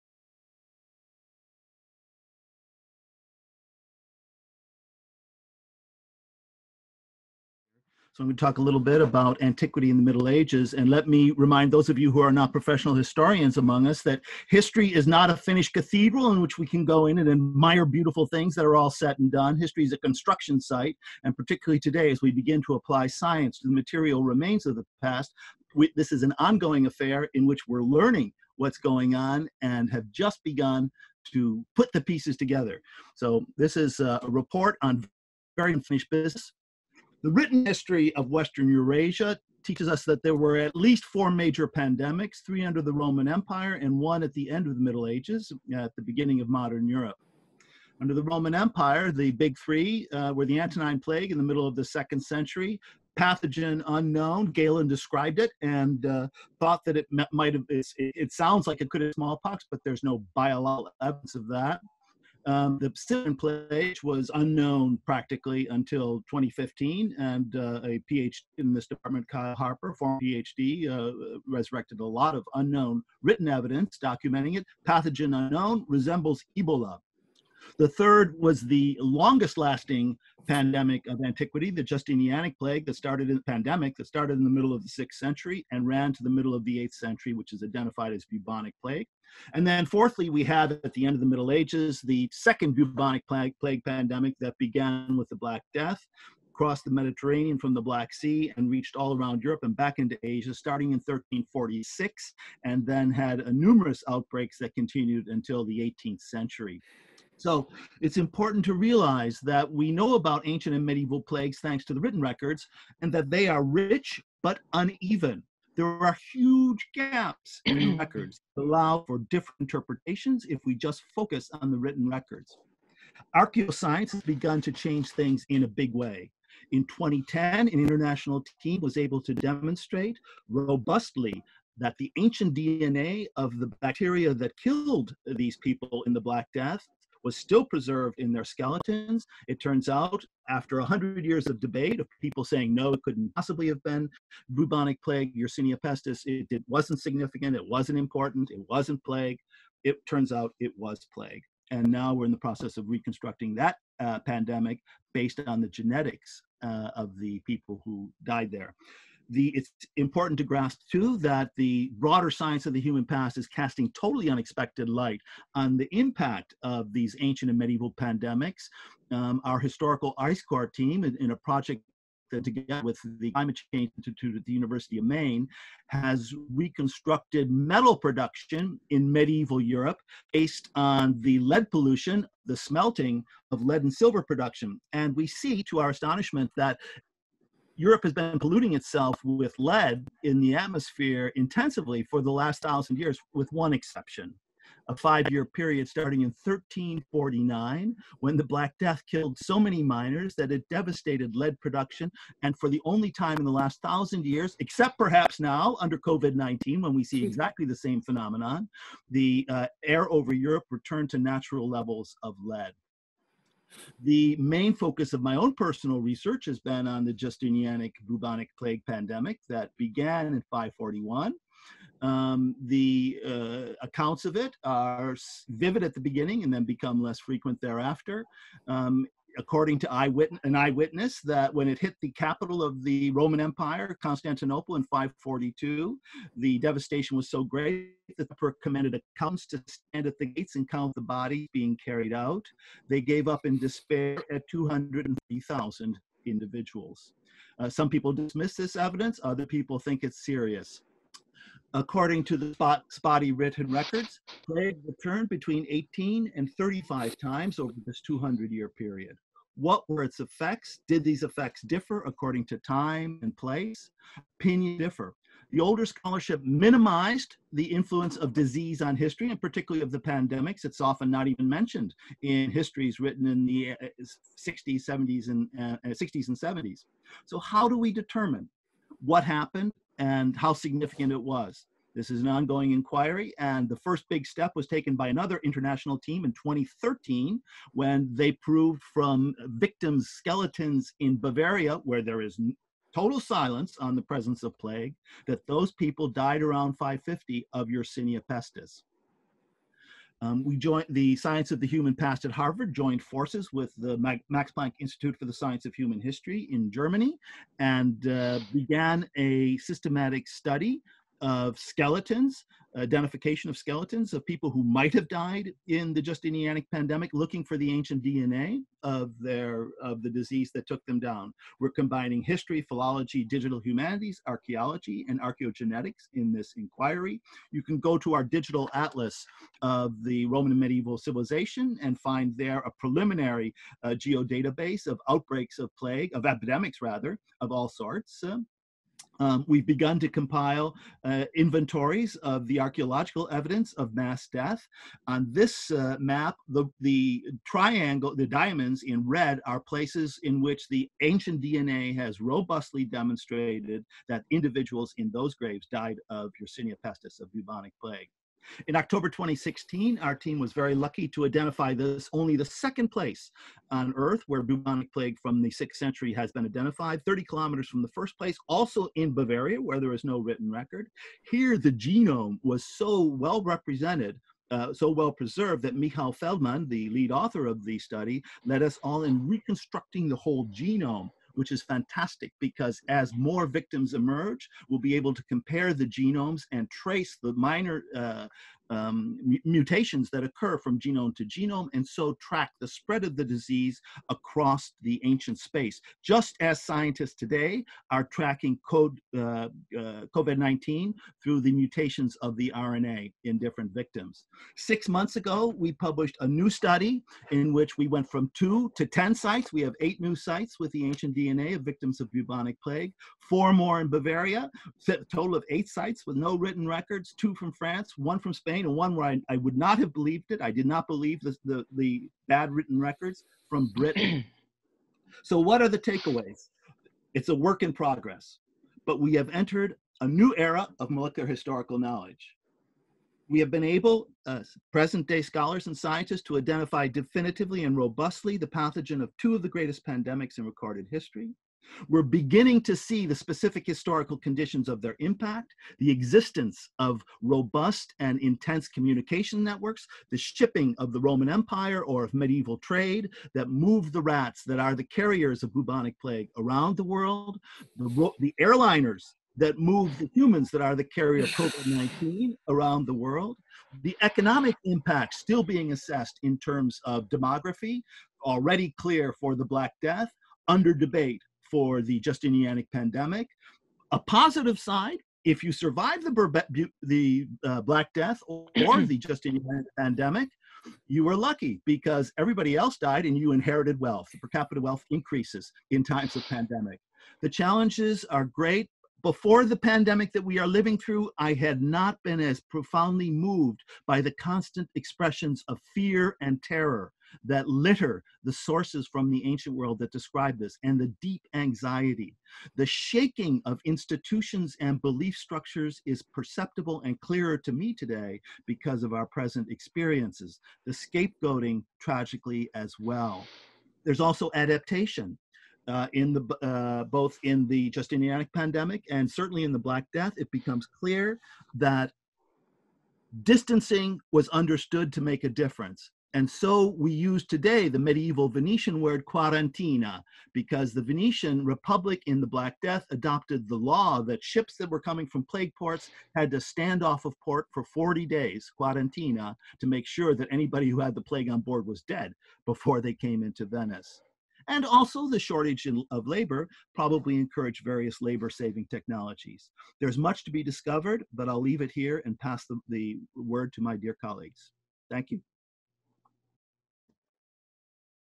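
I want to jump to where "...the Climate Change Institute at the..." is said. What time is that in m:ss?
2:53.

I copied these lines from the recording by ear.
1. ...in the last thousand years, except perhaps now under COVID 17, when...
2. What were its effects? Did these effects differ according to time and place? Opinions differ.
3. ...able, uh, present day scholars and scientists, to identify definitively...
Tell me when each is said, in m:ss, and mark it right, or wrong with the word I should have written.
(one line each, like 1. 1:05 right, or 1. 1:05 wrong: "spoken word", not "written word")
1. 3:23 wrong: "19", not "17"
2. 4:19 right
3. 7:13 right.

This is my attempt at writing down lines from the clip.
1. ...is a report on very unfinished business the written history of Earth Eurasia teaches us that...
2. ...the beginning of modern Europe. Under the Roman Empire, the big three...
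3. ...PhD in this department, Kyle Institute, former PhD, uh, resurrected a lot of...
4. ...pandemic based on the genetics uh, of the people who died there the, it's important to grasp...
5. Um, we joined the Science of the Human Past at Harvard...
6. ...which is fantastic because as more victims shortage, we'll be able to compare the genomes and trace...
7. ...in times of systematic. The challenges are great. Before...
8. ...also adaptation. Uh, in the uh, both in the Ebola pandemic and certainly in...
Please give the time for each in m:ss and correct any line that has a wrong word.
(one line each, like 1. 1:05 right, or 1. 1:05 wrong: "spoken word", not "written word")
1. 0:33 wrong: "Western", not "Earth"
2. 0:45 right
3. 1:08 wrong: "Harper", not "Institute"
4. 2:34 right
5. 5:00 right
6. 6:21 wrong: "emerge", not "shortage"
7. 8:05 wrong: "pandemic", not "systematic"
8. 8:34 wrong: "Justinianic", not "Ebola".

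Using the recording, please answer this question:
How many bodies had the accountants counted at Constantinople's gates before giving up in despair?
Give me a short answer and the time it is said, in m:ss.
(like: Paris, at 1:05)
203,000, at 4:04.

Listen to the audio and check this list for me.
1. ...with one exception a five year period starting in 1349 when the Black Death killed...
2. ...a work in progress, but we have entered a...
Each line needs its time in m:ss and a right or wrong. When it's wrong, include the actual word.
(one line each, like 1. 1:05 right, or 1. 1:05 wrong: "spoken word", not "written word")
1. 3:13 right
2. 7:07 right.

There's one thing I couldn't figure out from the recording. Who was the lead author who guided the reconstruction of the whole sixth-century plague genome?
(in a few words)
Michal Feldman.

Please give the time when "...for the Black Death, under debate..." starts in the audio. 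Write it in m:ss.
7:49.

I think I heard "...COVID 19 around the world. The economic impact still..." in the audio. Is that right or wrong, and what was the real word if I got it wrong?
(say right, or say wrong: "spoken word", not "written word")
right.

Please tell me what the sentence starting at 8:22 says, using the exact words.
The shaking of institutions and belief structures is perceptible and clearer to me today because of our present experiences.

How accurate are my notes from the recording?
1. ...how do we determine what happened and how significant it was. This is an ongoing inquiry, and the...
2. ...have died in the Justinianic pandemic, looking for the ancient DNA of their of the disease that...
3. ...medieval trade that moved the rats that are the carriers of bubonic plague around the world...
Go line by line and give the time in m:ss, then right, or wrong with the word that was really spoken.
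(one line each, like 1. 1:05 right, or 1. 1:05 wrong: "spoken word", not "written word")
1. 4:37 right
2. 5:14 right
3. 7:32 right.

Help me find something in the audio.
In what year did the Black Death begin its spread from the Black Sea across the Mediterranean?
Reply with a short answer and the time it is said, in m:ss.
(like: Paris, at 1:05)
1346, at 1:40.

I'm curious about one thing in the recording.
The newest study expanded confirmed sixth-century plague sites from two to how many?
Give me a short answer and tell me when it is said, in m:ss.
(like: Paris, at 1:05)
10, at 6:48.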